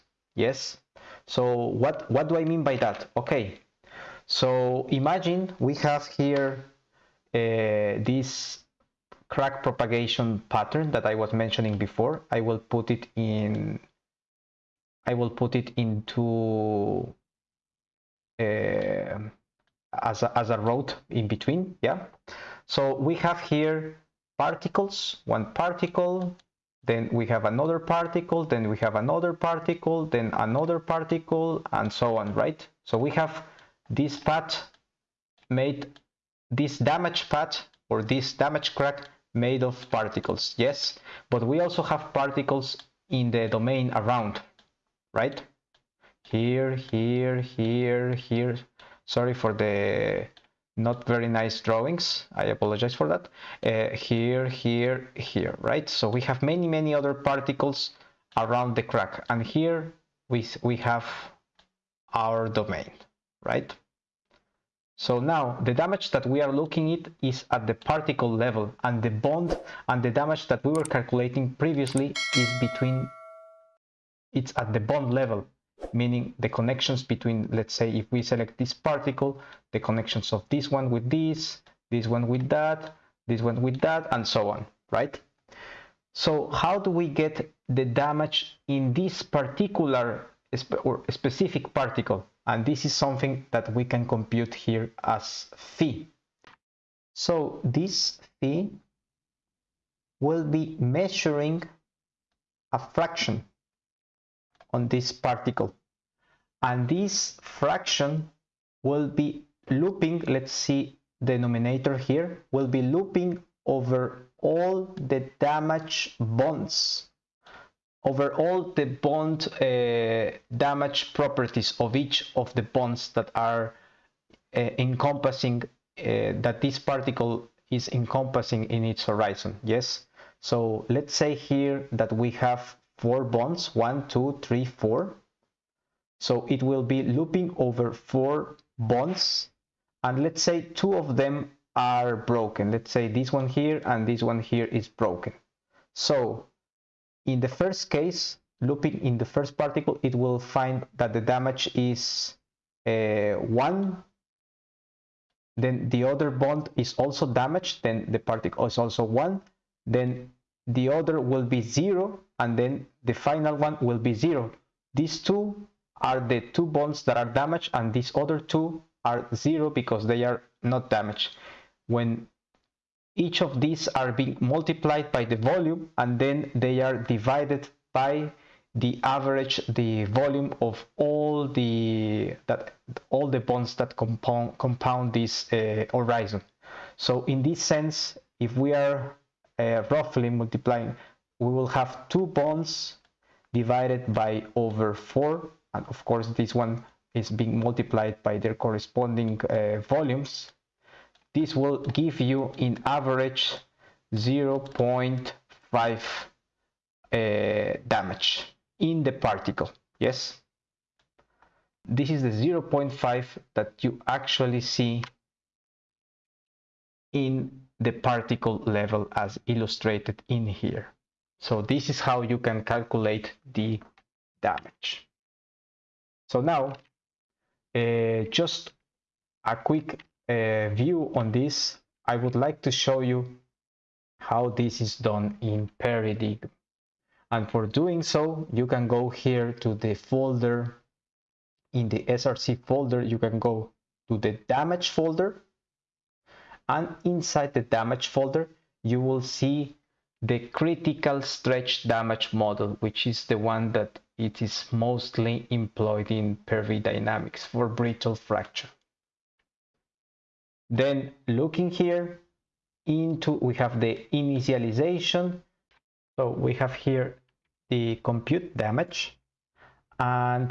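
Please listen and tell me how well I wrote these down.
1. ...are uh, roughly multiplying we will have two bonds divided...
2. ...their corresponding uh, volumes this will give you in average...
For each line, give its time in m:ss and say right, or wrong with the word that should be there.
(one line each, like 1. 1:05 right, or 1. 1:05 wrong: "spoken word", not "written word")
1. 3:08 right
2. 3:18 right.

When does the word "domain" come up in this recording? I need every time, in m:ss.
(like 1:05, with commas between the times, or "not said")
0:43, 1:02.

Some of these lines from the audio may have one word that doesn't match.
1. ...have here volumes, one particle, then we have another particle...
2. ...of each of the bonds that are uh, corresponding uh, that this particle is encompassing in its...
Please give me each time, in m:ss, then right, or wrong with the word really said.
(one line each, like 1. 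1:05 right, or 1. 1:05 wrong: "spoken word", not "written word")
1. 0:23 wrong: "particles", not "volumes"
2. 2:01 wrong: "encompassing", not "corresponding".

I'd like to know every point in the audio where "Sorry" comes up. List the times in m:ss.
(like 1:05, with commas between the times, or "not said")
0:49.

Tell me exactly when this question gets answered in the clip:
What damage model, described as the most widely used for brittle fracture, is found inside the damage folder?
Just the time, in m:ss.
4:10.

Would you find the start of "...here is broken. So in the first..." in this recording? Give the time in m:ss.
2:24.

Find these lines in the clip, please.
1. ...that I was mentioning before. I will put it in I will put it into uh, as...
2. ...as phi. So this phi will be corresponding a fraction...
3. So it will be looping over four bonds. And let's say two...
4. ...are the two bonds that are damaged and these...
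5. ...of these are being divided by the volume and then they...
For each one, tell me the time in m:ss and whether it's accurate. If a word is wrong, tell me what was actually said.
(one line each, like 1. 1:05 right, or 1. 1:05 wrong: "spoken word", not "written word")
1. 0:10 right
2. 1:35 wrong: "measuring", not "corresponding"
3. 2:16 right
4. 2:46 right
5. 2:53 wrong: "multiplied", not "divided".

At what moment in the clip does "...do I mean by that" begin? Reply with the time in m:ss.
0:02.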